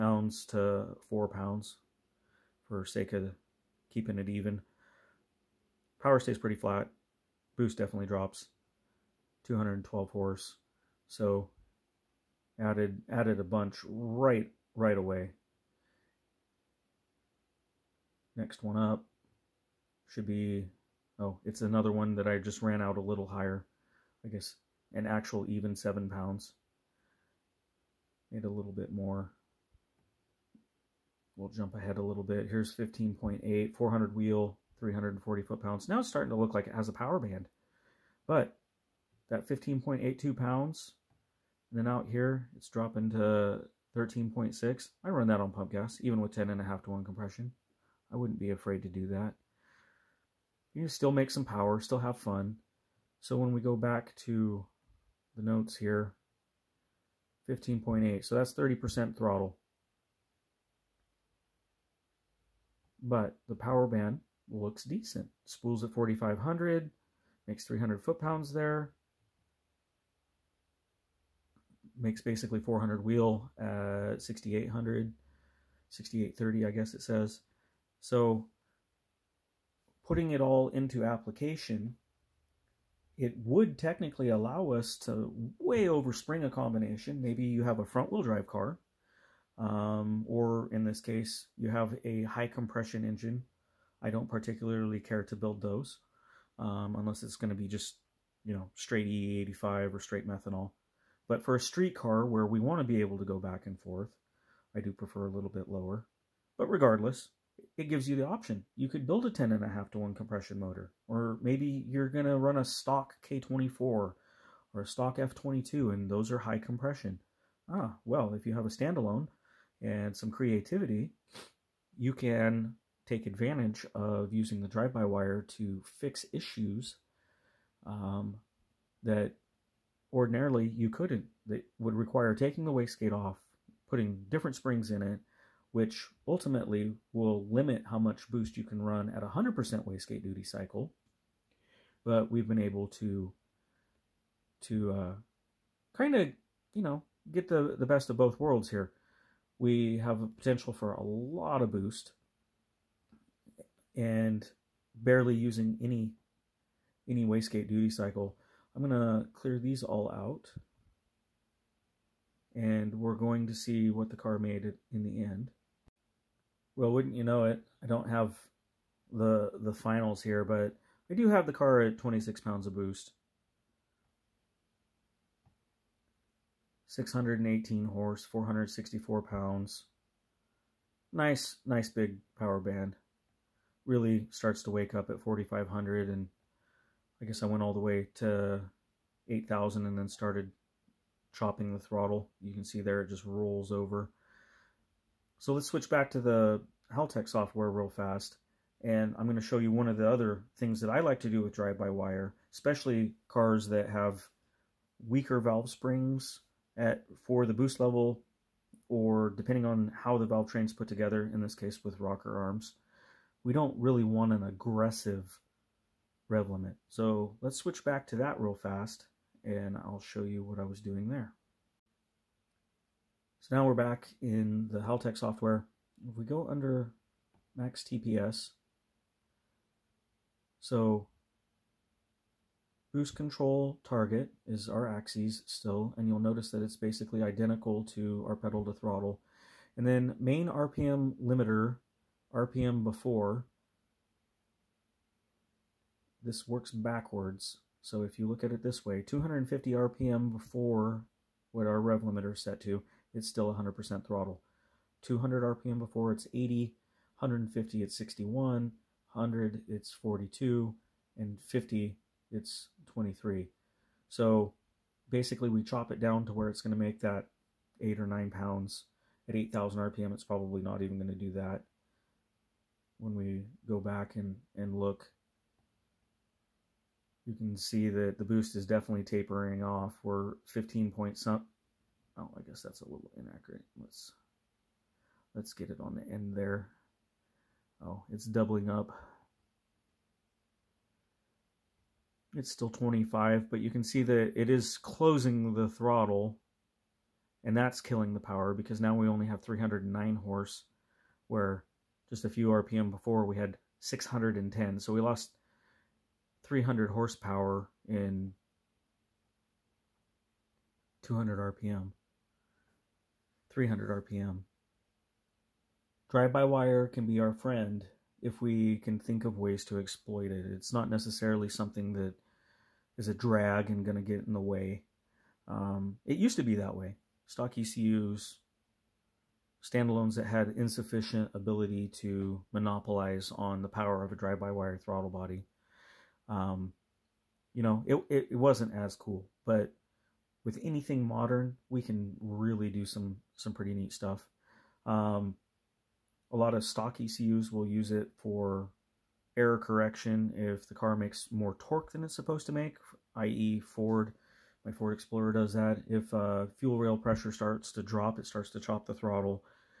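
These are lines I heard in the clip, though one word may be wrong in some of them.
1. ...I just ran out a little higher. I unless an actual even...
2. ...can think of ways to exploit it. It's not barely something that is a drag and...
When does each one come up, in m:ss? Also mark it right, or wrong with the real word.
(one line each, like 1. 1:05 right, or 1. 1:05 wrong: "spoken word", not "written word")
1. 0:22 wrong: "guess", not "unless"
2. 5:18 wrong: "necessarily", not "barely".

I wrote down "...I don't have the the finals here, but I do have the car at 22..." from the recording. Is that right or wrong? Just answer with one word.
wrong.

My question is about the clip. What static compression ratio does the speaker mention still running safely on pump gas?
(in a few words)
10.5 to 1.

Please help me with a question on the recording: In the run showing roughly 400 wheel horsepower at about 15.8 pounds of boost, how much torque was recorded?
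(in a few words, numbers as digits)
340 foot-pounds.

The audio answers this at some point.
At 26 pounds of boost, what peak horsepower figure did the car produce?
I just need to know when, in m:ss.
2:56.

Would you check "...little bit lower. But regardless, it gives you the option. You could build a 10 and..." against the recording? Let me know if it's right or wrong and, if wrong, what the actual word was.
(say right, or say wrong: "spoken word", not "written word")
right.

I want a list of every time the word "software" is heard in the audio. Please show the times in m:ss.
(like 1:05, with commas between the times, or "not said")
3:17, 3:45.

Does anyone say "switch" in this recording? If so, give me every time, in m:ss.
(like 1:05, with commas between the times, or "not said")
3:15, 3:37.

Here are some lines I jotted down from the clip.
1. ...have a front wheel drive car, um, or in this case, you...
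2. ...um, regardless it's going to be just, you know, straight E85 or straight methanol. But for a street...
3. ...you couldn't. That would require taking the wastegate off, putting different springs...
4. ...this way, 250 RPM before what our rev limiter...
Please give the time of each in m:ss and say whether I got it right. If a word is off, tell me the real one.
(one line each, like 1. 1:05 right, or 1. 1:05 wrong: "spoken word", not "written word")
1. 1:27 right
2. 1:36 wrong: "unless", not "regardless"
3. 2:10 right
4. 4:08 right.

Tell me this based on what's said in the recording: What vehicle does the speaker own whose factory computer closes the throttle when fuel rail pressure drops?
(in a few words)
Ford Explorer.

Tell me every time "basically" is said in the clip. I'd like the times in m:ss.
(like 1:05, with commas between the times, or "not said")
1:12, 3:56, 4:25.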